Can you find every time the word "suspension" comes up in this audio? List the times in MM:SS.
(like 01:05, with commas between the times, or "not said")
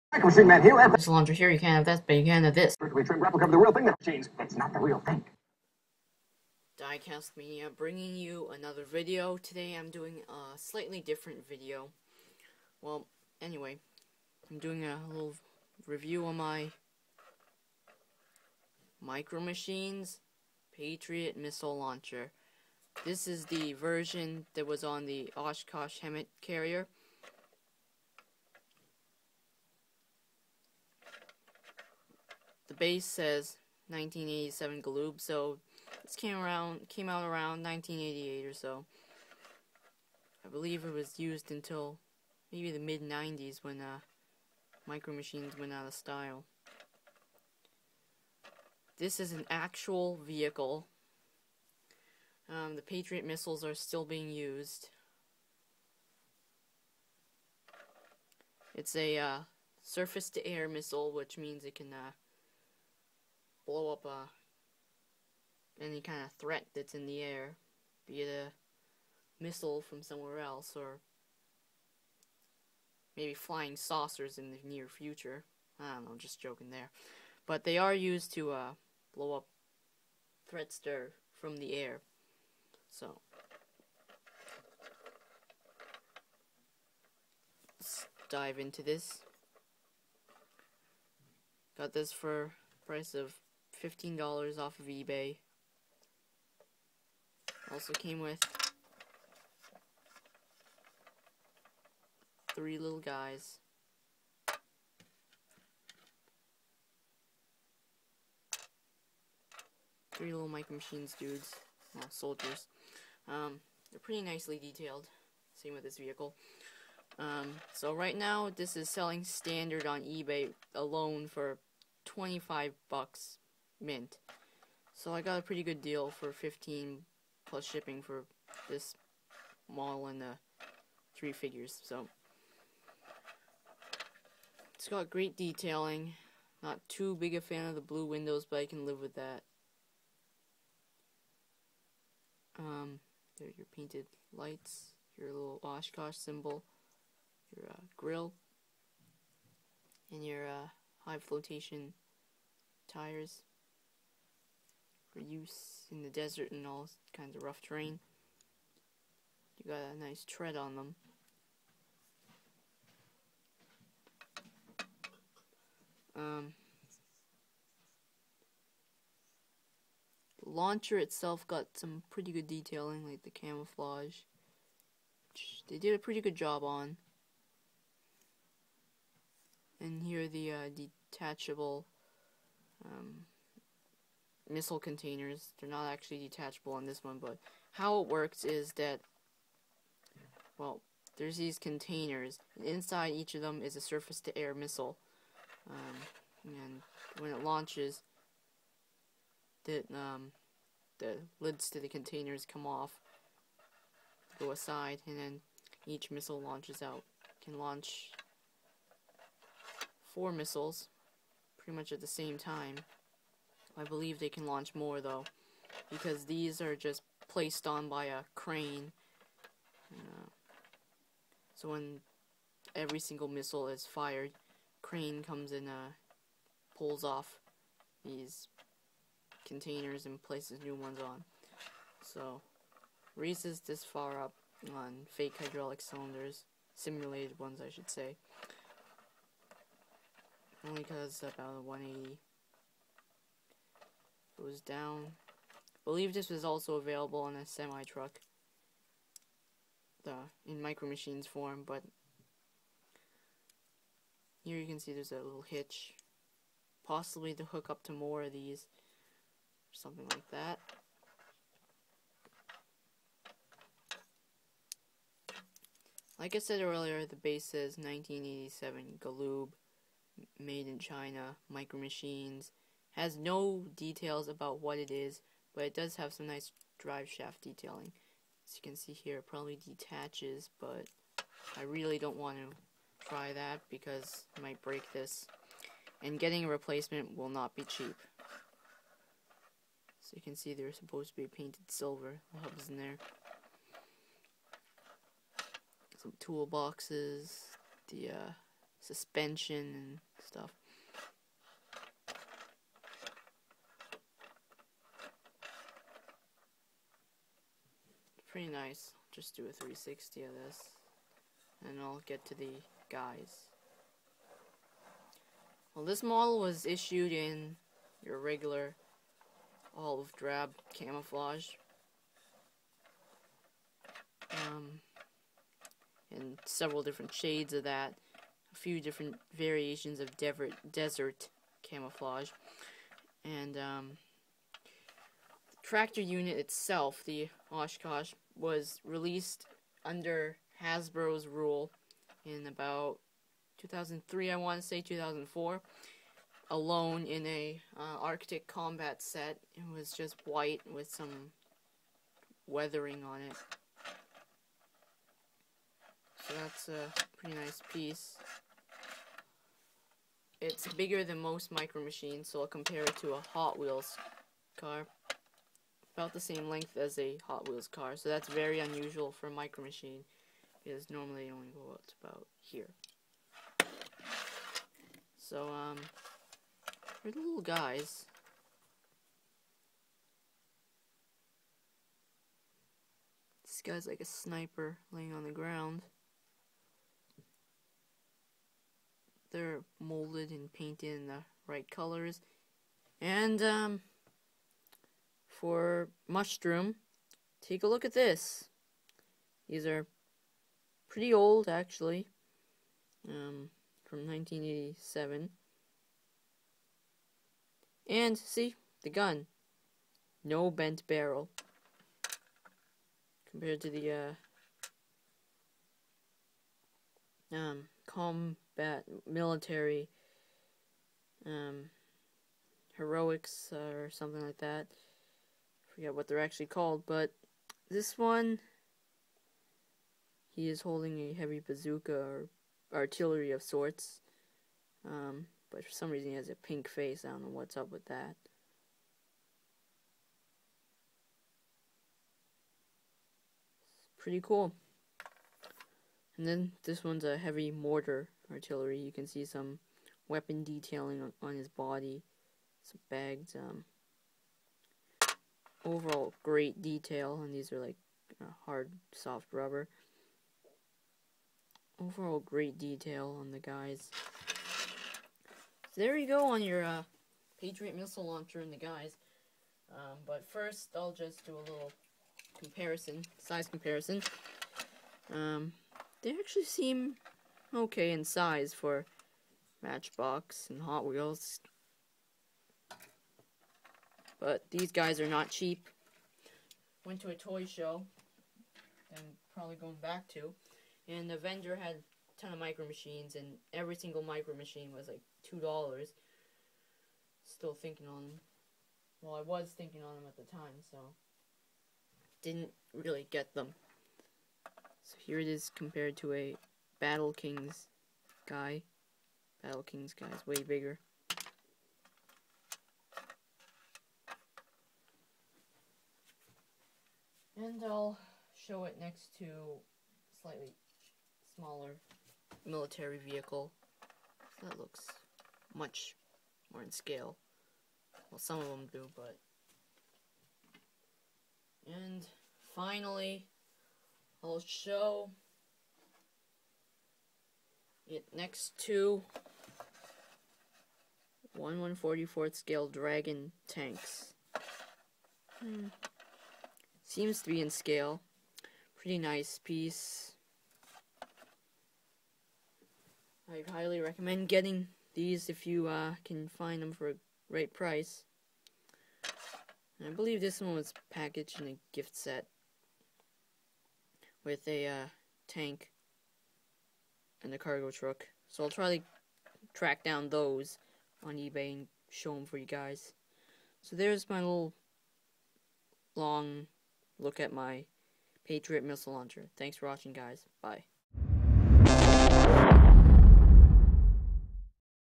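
04:58.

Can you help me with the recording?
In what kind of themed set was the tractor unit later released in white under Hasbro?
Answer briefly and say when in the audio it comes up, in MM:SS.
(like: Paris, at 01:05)
Arctic combat set, at 05:48.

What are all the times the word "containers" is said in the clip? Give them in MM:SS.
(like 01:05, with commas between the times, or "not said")
03:04, 03:11, 03:21, 03:49.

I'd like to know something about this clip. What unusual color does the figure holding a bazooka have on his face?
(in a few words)
pink.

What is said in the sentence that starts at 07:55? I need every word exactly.
Um, they actually seem okay in size for Matchbox and Hot Wheels but these guys are not cheap.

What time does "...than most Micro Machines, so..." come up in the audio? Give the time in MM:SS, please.
06:01.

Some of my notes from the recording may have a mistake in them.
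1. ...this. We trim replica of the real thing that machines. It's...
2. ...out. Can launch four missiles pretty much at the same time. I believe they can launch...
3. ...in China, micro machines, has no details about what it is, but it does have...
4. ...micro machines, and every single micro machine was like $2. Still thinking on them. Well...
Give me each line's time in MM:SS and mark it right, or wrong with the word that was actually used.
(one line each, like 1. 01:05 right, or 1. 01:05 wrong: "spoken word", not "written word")
1. 00:02 right
2. 03:26 right
3. 04:30 right
4. 08:12 right.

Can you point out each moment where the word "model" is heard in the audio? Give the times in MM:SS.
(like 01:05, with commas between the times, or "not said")
02:09, 05:16.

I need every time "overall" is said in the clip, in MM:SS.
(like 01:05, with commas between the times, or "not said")
07:35, 07:41.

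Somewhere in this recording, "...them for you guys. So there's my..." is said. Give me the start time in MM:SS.
09:32.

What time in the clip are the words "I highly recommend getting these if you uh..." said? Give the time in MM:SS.
09:13.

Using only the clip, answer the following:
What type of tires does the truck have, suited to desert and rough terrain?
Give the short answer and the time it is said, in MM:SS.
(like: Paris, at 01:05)
high flotation tires, at 02:31.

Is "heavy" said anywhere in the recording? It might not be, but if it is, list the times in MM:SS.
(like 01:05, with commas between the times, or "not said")
07:11, 07:27.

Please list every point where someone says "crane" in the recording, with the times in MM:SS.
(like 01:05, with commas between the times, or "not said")
03:38, 03:44.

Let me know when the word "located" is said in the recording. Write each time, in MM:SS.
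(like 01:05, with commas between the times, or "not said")
not said.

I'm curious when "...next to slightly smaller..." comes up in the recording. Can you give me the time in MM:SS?
08:38.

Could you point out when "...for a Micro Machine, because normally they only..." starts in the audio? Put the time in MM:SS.
06:09.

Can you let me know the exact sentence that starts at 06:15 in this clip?
So, um, they're the little guys.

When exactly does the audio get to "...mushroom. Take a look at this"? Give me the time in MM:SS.
06:36.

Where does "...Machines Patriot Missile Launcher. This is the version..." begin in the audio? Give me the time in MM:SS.
00:19.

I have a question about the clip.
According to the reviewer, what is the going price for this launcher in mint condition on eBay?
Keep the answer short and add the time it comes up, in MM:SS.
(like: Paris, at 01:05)
25 bucks, at 02:02.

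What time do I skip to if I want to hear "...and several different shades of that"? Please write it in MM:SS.
05:26.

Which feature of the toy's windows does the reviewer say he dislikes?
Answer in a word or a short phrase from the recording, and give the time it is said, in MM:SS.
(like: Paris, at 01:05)
blue windows, at 02:17.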